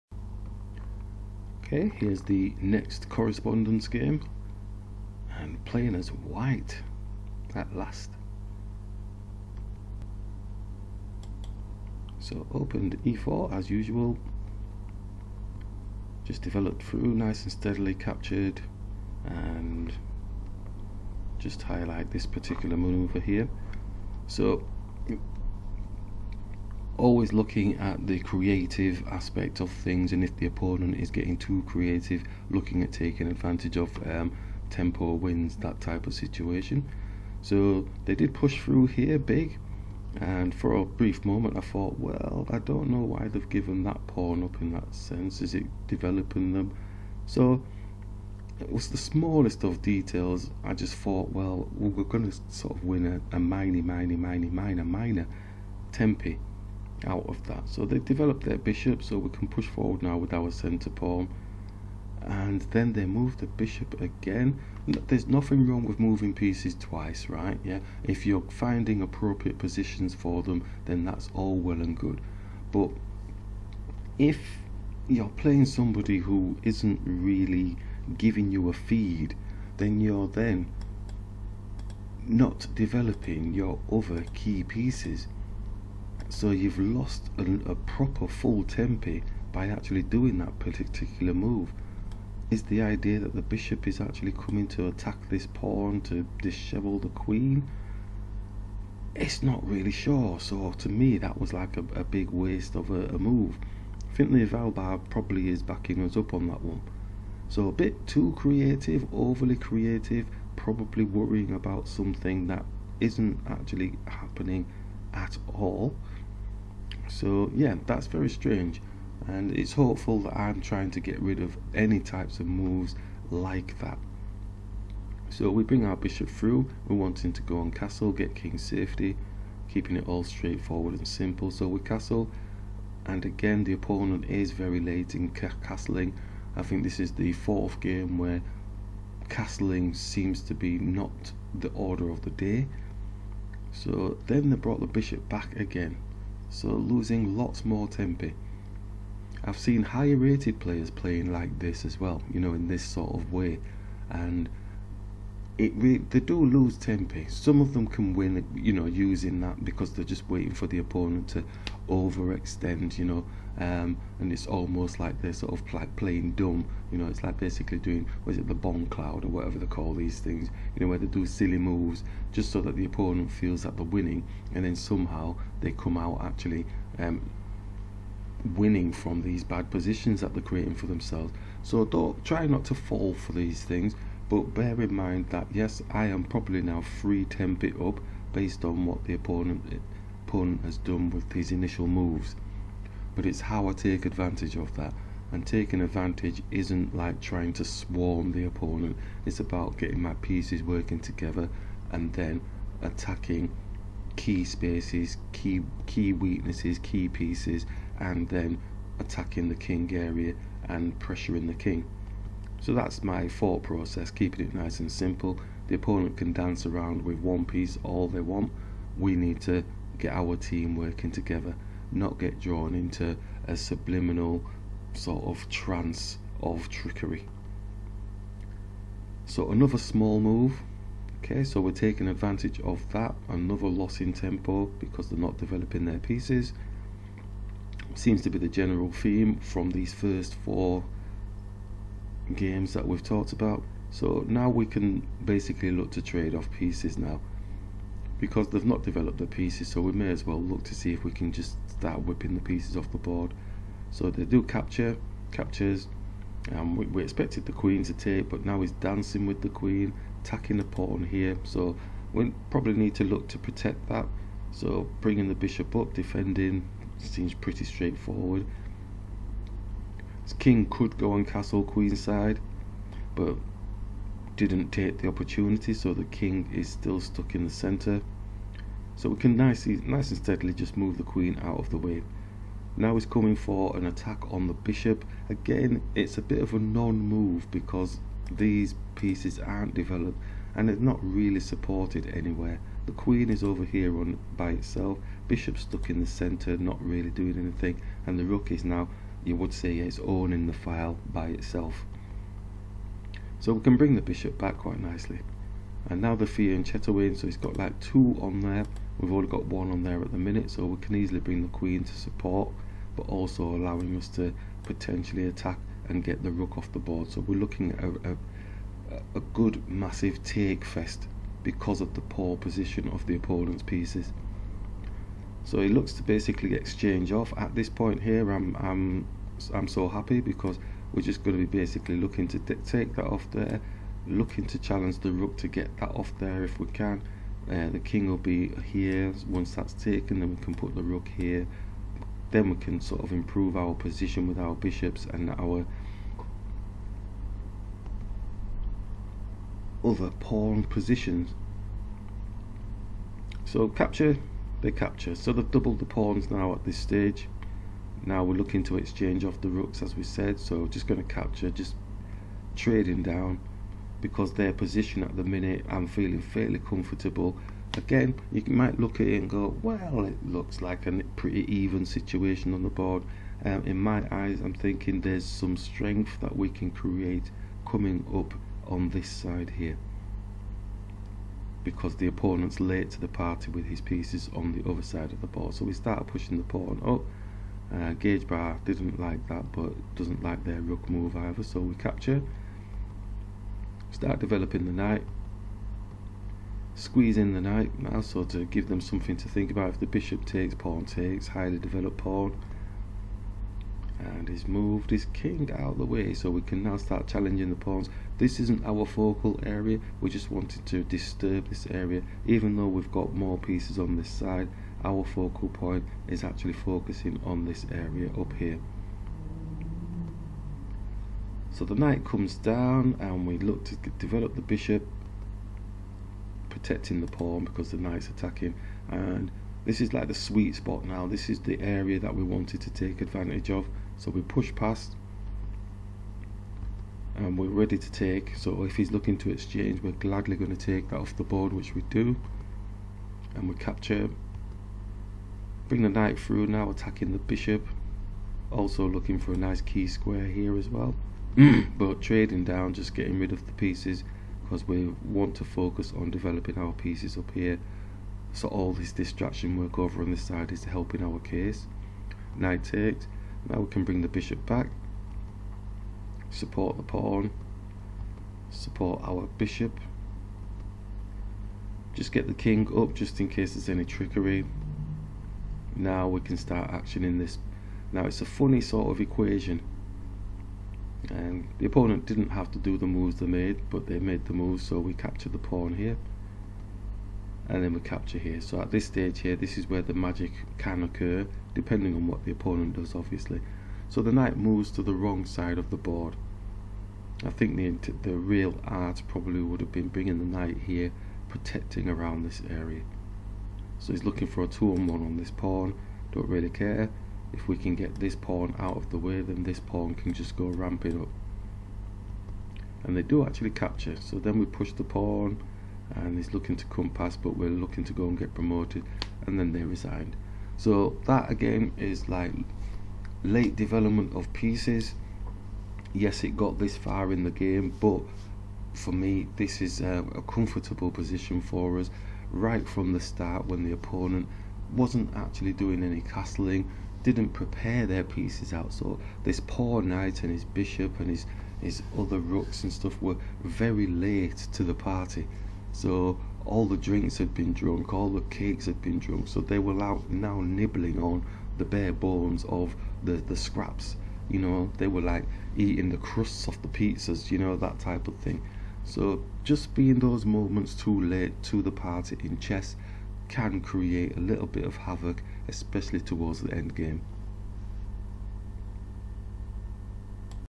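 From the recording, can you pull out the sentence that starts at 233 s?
Another loss in tempo because they're not developing their pieces.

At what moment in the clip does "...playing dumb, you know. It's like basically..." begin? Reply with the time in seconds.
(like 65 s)
165 s.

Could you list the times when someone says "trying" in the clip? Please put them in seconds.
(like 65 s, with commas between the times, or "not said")
120 s, 197 s.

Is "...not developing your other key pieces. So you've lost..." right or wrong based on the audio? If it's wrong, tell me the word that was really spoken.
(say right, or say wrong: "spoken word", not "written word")
right.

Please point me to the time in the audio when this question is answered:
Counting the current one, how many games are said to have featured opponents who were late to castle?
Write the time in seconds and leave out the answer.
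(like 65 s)
137 s.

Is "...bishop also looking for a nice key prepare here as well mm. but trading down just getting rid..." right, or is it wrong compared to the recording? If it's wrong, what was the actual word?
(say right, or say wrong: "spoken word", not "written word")
wrong: "square", not "prepare".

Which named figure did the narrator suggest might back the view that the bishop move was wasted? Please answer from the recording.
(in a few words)
Finley Valbar.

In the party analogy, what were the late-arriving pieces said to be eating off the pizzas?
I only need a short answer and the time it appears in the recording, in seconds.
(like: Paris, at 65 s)
crusts, at 555 s.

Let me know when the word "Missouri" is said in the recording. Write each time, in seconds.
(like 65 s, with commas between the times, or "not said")
not said.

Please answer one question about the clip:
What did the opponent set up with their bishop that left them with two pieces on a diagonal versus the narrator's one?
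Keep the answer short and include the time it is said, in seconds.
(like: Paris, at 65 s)
fianchetto, at 306 s.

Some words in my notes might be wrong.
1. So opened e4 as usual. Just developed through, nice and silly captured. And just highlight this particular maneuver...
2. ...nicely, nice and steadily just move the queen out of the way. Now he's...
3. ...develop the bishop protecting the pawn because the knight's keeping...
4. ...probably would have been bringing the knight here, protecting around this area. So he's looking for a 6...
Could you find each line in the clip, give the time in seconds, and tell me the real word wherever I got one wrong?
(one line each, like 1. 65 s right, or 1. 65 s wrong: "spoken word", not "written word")
1. 12 s wrong: "steadily", not "silly"
2. 279 s right
3. 423 s wrong: "attacking", not "keeping"
4. 499 s wrong: "2", not "6".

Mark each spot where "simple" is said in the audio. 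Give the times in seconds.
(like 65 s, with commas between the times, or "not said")
131 s, 214 s.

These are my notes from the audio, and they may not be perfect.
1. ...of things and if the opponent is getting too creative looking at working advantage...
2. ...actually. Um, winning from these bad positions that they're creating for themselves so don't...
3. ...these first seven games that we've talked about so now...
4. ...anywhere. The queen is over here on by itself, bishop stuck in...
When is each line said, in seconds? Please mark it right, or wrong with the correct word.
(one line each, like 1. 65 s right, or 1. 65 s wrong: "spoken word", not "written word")
1. 29 s wrong: "taking", not "working"
2. 176 s right
3. 239 s wrong: "four", not "seven"
4. 292 s right.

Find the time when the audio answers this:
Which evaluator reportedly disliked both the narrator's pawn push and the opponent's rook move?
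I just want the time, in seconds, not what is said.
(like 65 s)
387 s.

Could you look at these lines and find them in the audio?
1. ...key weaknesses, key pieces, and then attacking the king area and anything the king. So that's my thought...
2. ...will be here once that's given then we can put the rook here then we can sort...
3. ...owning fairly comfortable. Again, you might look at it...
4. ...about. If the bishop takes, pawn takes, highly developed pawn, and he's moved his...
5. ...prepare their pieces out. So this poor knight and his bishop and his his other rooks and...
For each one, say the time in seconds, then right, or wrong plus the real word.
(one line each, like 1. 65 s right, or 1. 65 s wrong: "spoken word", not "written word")
1. 205 s wrong: "pressuring", not "anything"
2. 338 s wrong: "taken", not "given"
3. 365 s wrong: "feeling", not "owning"
4. 399 s right
5. 537 s right.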